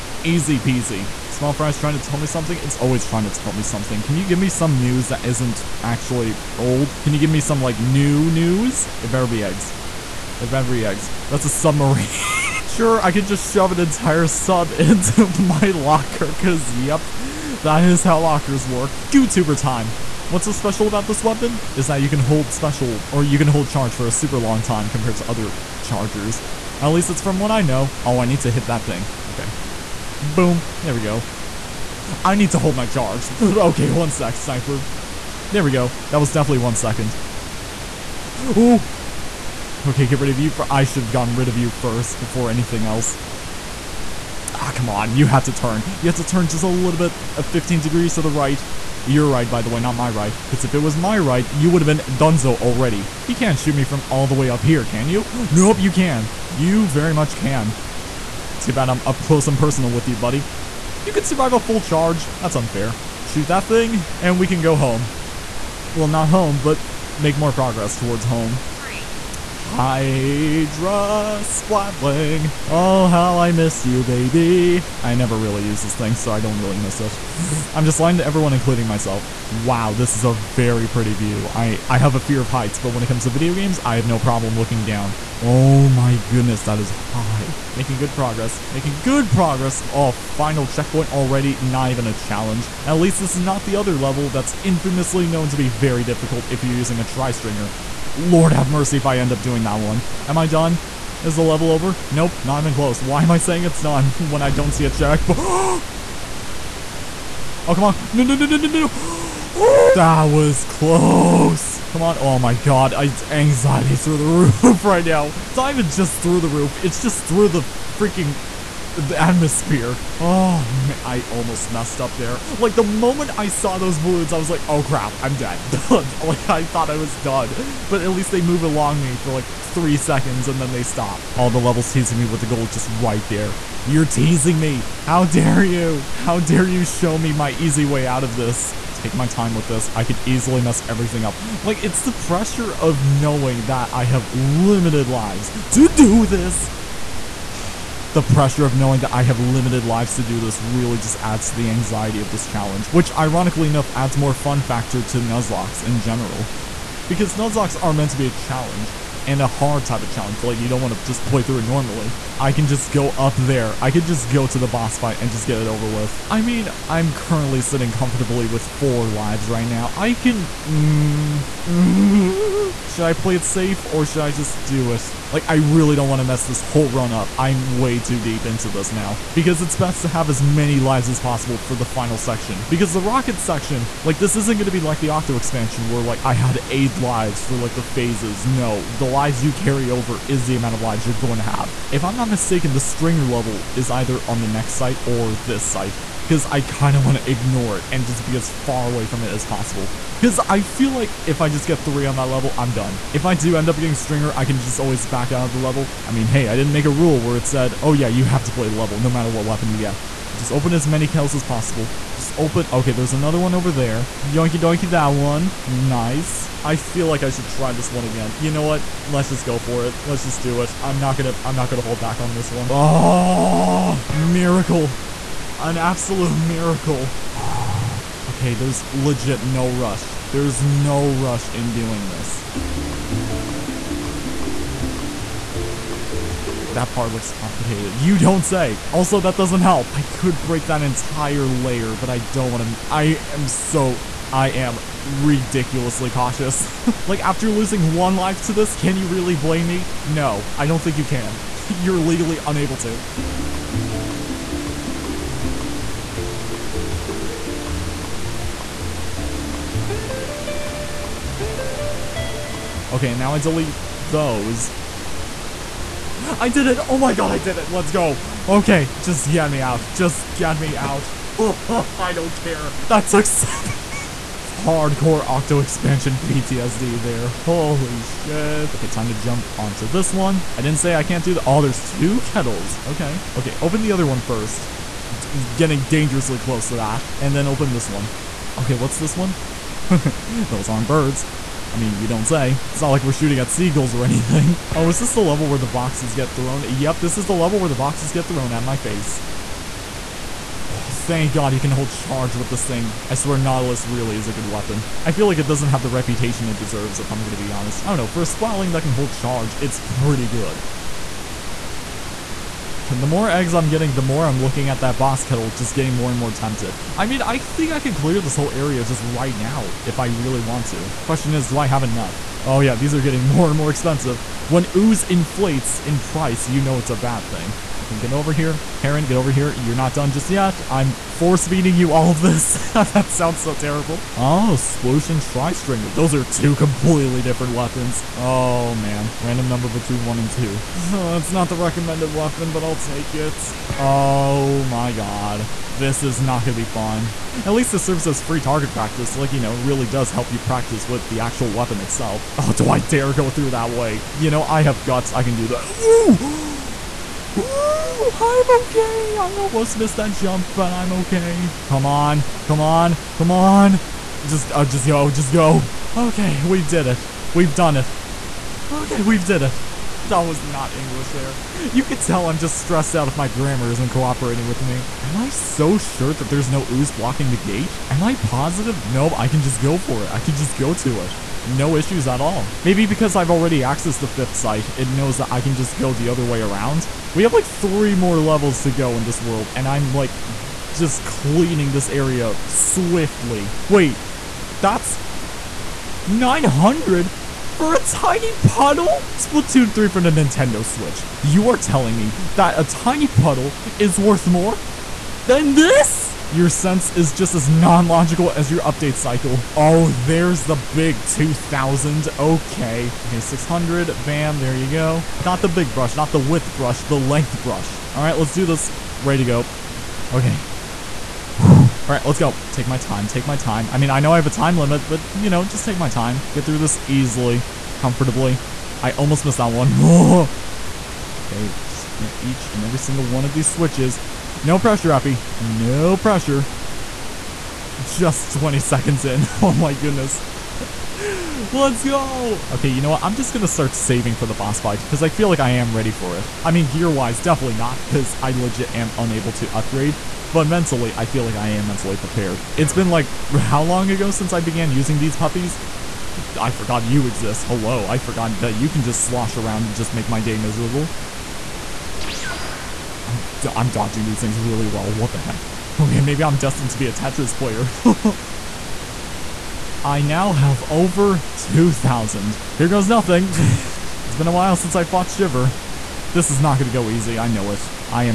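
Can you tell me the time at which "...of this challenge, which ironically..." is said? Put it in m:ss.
2:32.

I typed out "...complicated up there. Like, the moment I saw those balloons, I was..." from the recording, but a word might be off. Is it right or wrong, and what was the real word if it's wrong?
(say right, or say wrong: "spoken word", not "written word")
wrong: "messed", not "complicated".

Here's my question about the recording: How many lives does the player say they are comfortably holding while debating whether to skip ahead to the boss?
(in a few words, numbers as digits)
4.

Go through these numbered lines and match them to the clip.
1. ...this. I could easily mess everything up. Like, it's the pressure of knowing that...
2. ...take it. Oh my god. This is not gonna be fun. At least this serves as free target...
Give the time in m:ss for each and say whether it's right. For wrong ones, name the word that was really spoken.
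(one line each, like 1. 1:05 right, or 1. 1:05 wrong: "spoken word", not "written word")
1. 2:19 right
2. 5:42 right.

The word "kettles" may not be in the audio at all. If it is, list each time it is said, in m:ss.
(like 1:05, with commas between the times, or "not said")
4:42, 5:15.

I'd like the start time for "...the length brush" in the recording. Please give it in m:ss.
6:56.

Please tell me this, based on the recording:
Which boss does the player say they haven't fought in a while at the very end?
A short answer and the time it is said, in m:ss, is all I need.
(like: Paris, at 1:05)
Shiver, at 7:55.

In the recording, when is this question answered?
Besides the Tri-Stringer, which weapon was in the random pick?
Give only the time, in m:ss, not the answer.
5:34.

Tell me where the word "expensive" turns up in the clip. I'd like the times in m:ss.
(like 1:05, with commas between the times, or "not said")
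5:23.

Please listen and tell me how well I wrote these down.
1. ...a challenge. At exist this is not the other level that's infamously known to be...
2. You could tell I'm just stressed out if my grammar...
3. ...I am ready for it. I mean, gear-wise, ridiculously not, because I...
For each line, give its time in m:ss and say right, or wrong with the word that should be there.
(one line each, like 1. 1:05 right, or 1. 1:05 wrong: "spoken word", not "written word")
1. 1:32 wrong: "least", not "exist"
2. 6:11 right
3. 7:25 wrong: "definitely", not "ridiculously".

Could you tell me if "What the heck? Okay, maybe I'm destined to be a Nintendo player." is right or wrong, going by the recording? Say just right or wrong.
wrong.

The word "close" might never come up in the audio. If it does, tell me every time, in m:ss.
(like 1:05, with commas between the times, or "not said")
0:59, 1:42, 1:50, 4:46.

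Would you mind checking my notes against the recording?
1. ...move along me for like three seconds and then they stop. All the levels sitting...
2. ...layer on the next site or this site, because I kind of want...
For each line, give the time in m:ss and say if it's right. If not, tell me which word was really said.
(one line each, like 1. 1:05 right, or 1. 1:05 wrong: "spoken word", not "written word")
1. 2:08 wrong: "teasing", not "sitting"
2. 3:13 wrong: "either", not "layer".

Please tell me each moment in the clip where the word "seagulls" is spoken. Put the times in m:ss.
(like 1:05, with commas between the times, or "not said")
4:53.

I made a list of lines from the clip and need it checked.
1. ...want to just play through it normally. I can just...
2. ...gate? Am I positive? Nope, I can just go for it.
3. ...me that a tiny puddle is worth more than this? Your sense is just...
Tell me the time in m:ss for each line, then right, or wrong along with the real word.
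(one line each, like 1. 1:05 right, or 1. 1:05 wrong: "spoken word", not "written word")
1. 2:40 right
2. 6:17 right
3. 6:41 right.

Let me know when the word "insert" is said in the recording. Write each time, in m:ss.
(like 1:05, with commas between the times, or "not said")
not said.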